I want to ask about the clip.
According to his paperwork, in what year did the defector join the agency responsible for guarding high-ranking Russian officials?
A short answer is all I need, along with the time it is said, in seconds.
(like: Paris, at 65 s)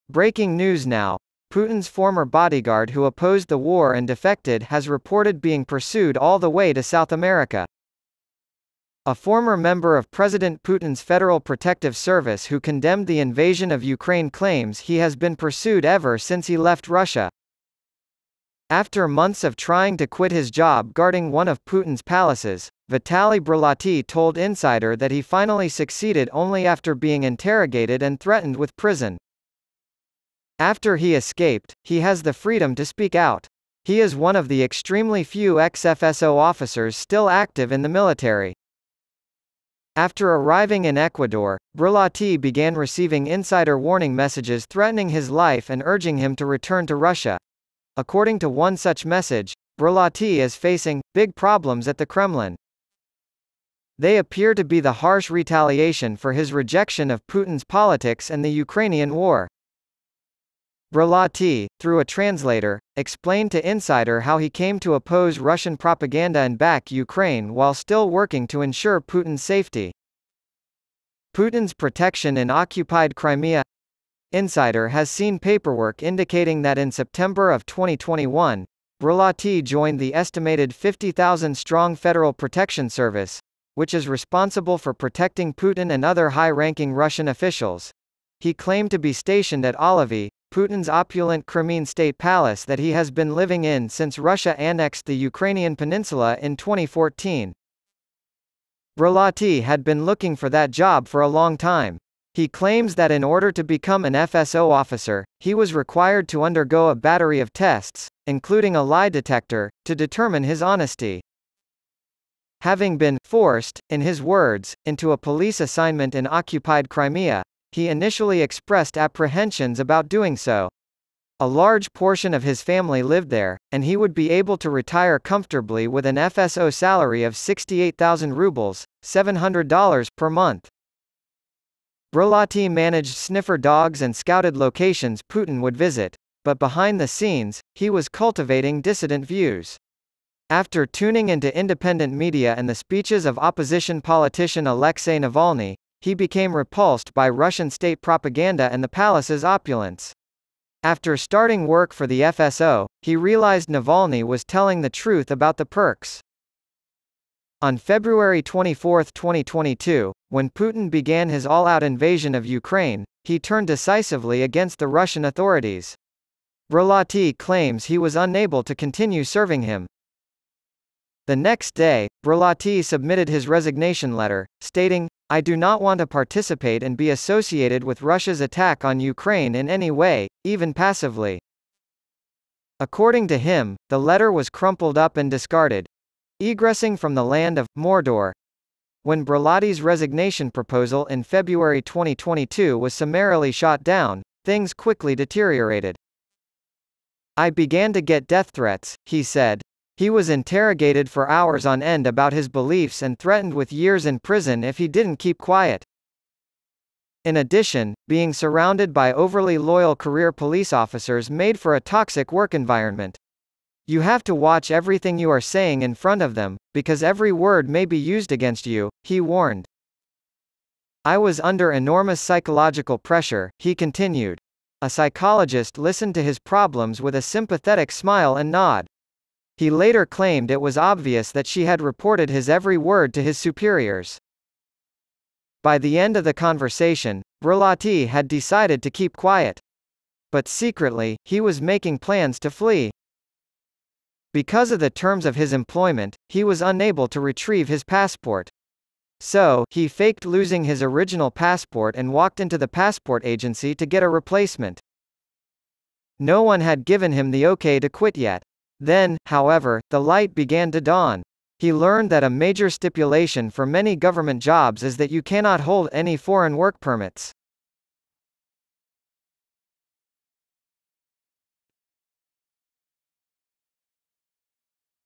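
2021, at 77 s.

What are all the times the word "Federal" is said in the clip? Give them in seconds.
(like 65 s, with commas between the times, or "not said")
11 s, 81 s.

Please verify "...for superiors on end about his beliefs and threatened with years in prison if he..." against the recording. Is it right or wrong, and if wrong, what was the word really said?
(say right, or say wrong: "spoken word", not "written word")
wrong: "hours", not "superiors".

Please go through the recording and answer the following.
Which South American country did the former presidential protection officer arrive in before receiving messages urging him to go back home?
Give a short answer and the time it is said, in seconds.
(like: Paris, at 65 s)
Ecuador, at 40 s.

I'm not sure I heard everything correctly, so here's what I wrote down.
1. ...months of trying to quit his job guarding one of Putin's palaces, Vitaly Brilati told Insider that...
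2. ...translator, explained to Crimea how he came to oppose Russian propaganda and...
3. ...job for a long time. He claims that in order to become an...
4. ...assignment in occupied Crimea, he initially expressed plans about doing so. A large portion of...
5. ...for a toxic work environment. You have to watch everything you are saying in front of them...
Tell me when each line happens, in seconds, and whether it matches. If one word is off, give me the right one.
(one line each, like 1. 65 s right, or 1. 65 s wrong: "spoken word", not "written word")
1. 19 s right
2. 62 s wrong: "Insider", not "Crimea"
3. 100 s right
4. 115 s wrong: "apprehensions", not "plans"
5. 211 s right.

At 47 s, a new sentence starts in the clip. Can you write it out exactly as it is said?
According to one such message, Brulati is facing big problems at the Kremlin.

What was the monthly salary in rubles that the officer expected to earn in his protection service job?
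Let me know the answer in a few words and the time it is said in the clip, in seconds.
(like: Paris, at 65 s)
68,000 rubles, at 127 s.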